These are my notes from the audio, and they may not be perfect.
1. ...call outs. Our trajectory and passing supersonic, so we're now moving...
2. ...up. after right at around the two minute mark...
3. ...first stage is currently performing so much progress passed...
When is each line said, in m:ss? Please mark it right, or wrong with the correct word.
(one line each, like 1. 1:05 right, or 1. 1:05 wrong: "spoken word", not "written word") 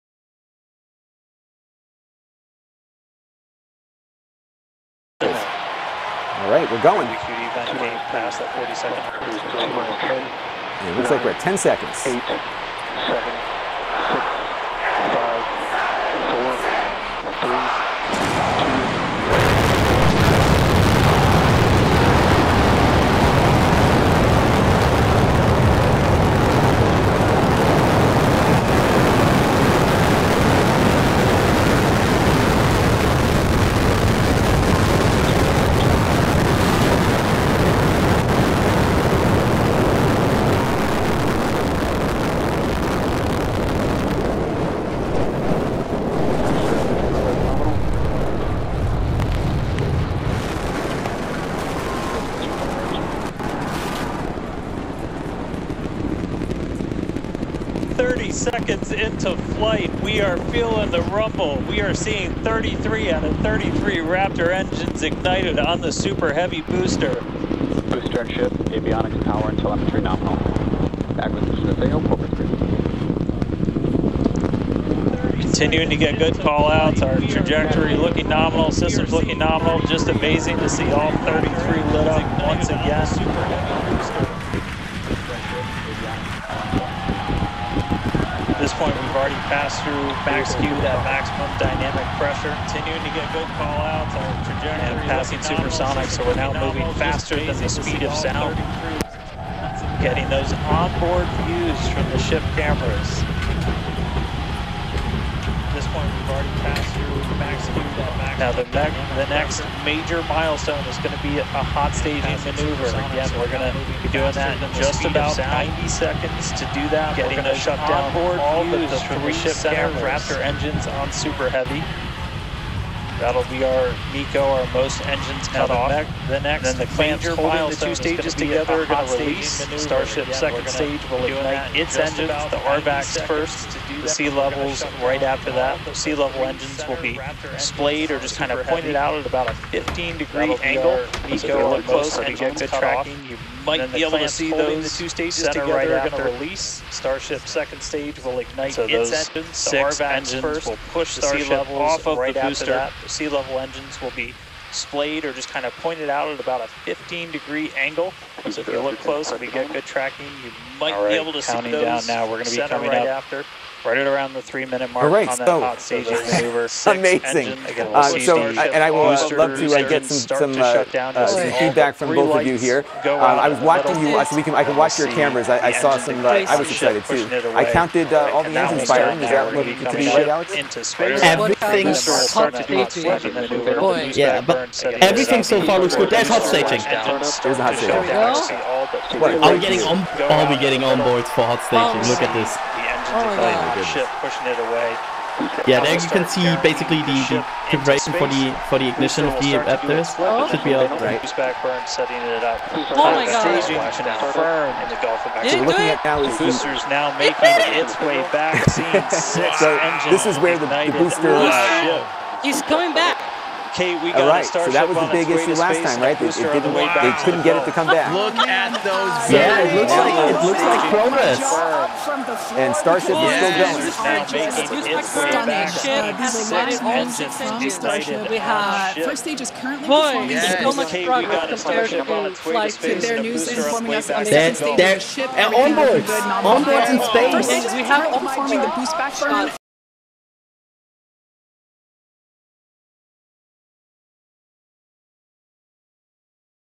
1. 1:33 right
2. 2:43 wrong: "three", not "two"
3. 3:48 wrong: "compared", not "passed".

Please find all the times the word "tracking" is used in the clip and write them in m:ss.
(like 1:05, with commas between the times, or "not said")
2:22, 2:39.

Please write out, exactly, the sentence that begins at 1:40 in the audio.
Getting those onboard views from the ship cameras this point, we've already passed through the max speed that max.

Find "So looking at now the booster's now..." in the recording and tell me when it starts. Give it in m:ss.
3:25.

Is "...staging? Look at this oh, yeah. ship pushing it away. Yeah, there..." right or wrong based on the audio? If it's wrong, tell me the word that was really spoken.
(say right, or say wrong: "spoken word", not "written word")
right.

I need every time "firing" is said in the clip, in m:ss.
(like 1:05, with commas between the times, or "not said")
2:58.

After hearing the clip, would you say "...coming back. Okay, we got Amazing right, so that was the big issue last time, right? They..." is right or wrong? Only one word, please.
wrong.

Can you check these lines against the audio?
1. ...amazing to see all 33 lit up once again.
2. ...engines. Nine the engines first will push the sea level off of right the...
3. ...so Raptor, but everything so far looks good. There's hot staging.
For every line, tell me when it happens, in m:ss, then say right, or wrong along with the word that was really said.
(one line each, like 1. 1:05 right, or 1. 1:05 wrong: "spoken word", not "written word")
1. 1:20 right
2. 2:29 wrong: "Six", not "Nine"
3. 3:01 wrong: "Yeah", not "Raptor".